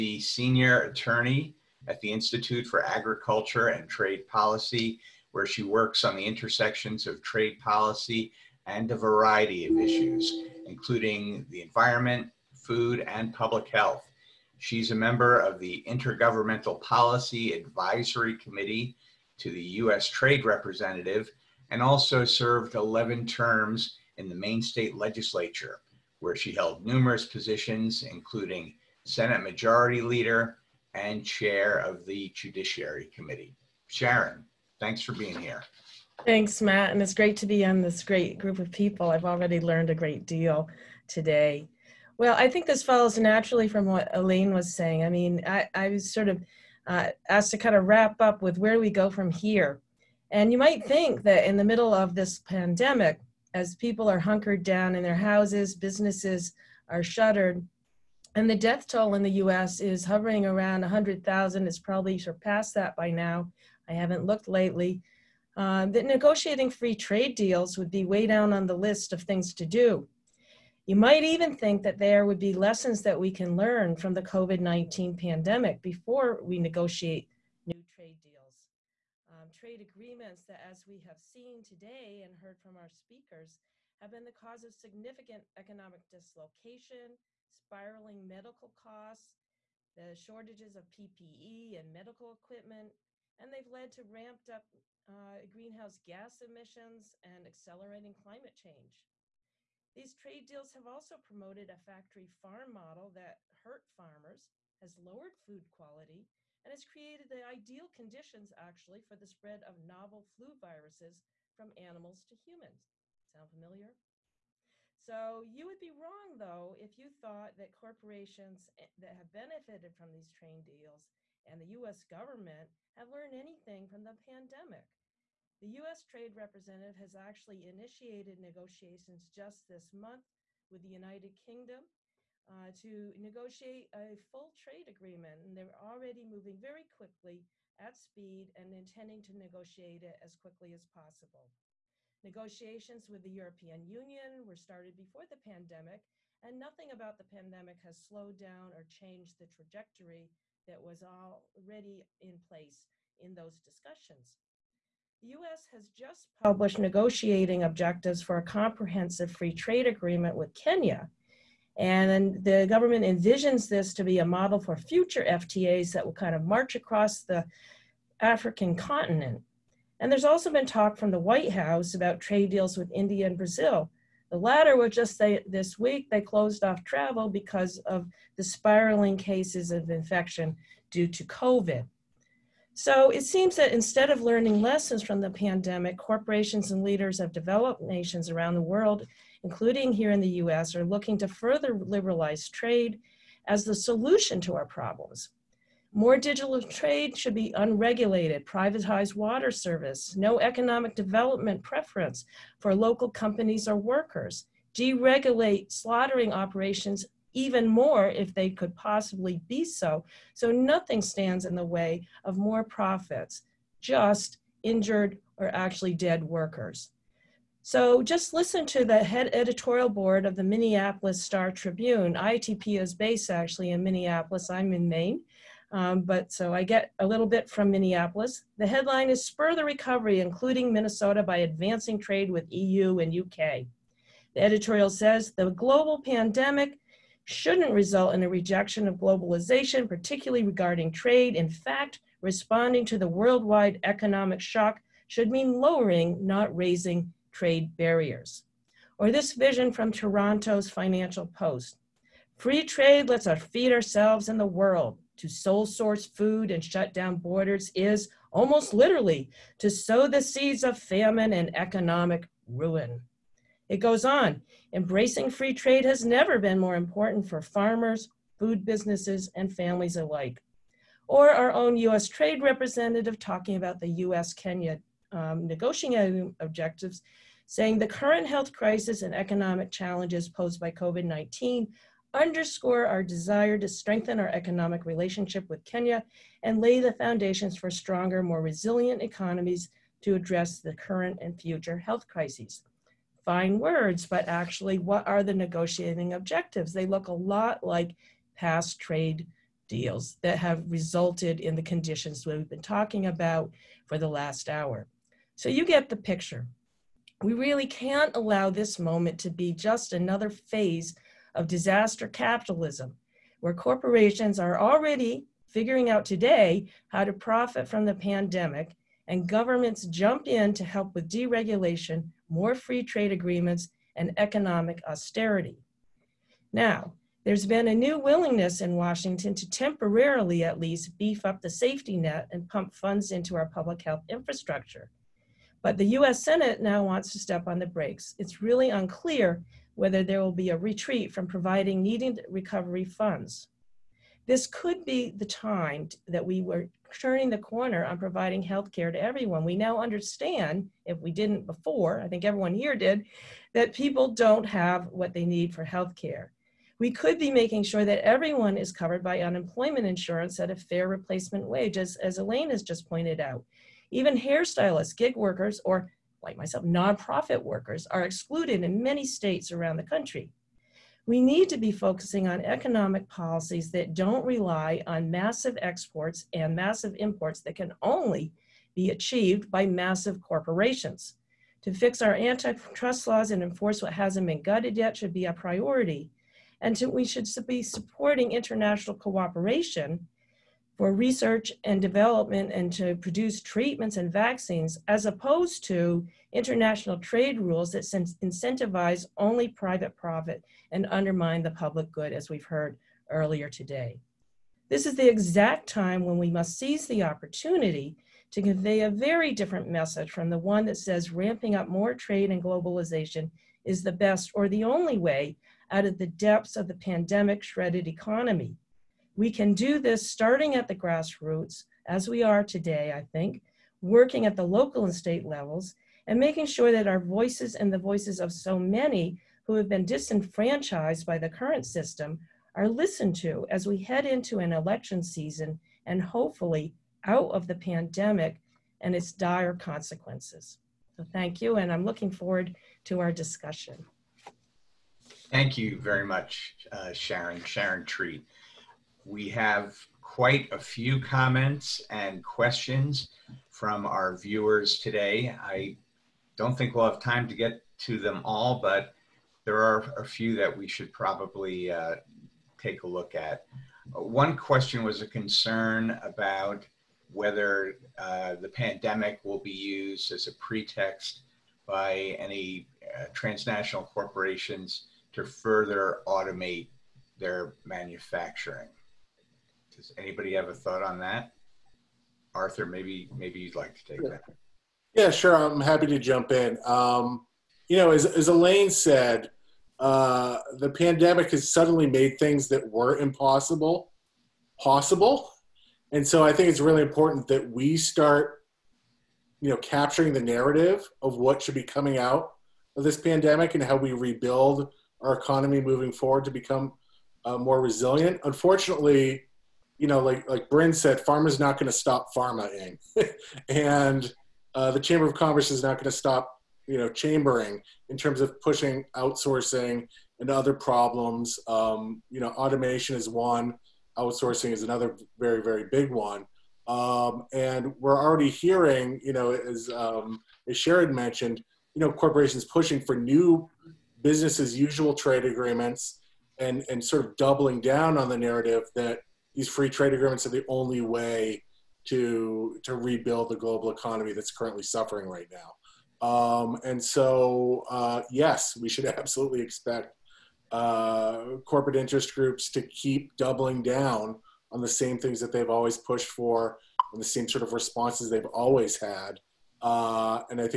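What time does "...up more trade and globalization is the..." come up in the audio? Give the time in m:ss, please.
6:51.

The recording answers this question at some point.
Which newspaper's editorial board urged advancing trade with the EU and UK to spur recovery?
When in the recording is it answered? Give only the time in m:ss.
3:40.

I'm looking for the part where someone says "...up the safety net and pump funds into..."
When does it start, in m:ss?
5:31.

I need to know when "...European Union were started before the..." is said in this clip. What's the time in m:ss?
2:23.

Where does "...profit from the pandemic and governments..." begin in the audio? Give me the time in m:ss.
5:17.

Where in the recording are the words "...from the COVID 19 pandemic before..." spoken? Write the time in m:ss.
1:13.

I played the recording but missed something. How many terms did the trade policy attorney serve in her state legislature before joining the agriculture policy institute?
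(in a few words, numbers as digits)
11.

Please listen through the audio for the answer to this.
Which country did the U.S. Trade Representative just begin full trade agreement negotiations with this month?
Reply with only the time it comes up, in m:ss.
2:10.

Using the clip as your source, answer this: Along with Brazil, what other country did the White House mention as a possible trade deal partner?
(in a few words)
India.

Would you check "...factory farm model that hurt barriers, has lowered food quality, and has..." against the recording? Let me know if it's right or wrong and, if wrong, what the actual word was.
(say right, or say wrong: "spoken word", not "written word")
wrong: "farmers", not "barriers".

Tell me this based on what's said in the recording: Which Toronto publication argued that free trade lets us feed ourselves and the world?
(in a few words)
Financial Post.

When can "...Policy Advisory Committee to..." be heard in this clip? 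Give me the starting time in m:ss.
0:16.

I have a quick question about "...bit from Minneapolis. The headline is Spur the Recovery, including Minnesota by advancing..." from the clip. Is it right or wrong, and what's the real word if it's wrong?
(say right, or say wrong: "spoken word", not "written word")
right.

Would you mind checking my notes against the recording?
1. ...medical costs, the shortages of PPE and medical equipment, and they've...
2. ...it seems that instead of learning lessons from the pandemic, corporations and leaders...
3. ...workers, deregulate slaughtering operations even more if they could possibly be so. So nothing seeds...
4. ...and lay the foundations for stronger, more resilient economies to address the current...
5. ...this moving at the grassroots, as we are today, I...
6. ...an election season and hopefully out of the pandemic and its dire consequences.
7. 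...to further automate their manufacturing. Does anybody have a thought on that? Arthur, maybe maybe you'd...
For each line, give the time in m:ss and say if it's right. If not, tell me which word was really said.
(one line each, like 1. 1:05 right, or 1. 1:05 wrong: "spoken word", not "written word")
1. 1:28 right
2. 3:03 right
3. 3:23 wrong: "stands", not "seeds"
4. 4:46 right
5. 6:59 wrong: "starting", not "moving"
6. 7:14 right
7. 7:55 right.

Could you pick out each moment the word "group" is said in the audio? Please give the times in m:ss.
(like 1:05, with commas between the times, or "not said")
0:38, 9:12.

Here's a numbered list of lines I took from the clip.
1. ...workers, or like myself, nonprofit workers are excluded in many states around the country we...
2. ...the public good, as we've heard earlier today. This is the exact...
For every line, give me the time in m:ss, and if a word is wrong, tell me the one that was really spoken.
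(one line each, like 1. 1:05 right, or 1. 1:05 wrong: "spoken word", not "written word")
1. 6:05 right
2. 6:41 right.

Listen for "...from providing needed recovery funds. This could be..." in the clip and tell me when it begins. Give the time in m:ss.
5:41.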